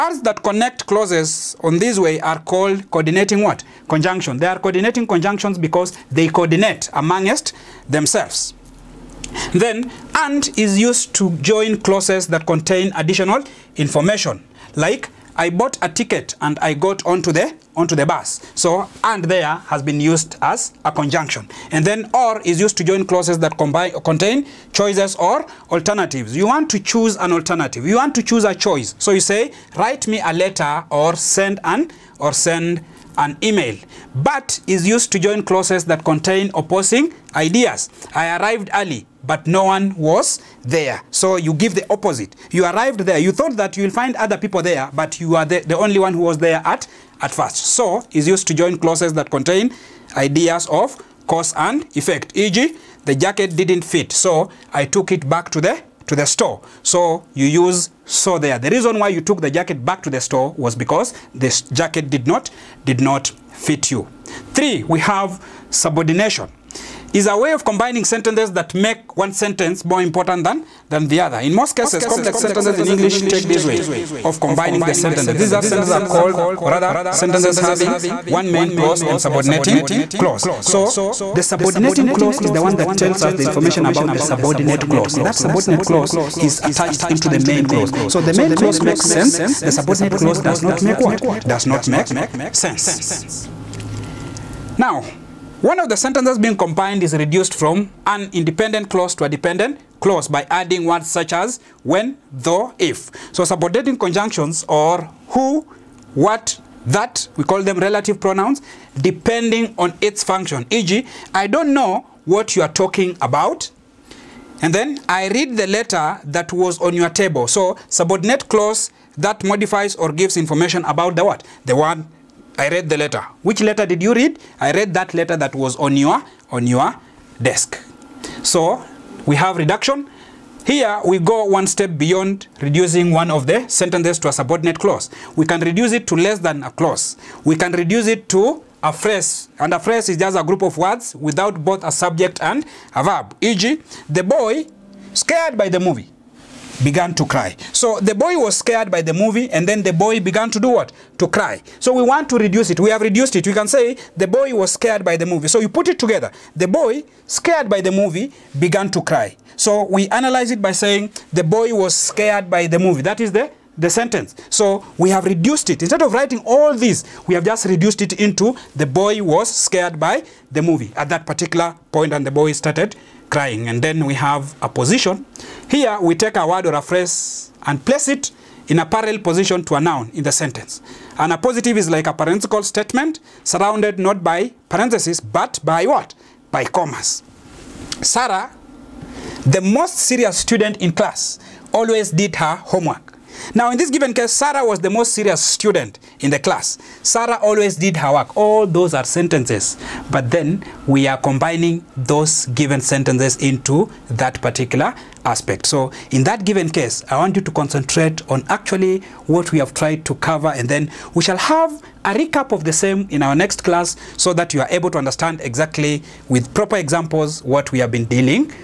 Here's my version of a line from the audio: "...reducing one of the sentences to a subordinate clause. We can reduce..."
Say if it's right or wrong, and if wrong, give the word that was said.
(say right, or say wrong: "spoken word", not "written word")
right.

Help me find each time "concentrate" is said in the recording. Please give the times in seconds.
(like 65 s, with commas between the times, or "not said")
207 s.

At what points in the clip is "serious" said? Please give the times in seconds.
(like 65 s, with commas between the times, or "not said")
189 s, 195 s.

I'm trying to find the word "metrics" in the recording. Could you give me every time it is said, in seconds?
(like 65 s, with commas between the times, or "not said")
not said.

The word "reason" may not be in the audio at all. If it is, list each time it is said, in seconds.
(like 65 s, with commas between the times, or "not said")
58 s.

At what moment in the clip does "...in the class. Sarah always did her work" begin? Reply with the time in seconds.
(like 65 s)
196 s.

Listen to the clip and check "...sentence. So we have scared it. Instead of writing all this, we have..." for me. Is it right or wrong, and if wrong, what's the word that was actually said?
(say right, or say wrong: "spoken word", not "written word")
wrong: "reduced", not "scared".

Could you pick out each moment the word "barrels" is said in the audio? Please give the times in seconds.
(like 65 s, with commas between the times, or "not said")
not said.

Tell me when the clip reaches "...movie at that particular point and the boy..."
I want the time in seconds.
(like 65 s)
170 s.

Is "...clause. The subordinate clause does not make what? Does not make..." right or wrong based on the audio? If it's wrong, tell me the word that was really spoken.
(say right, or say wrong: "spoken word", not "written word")
wrong: "sense", not "clause".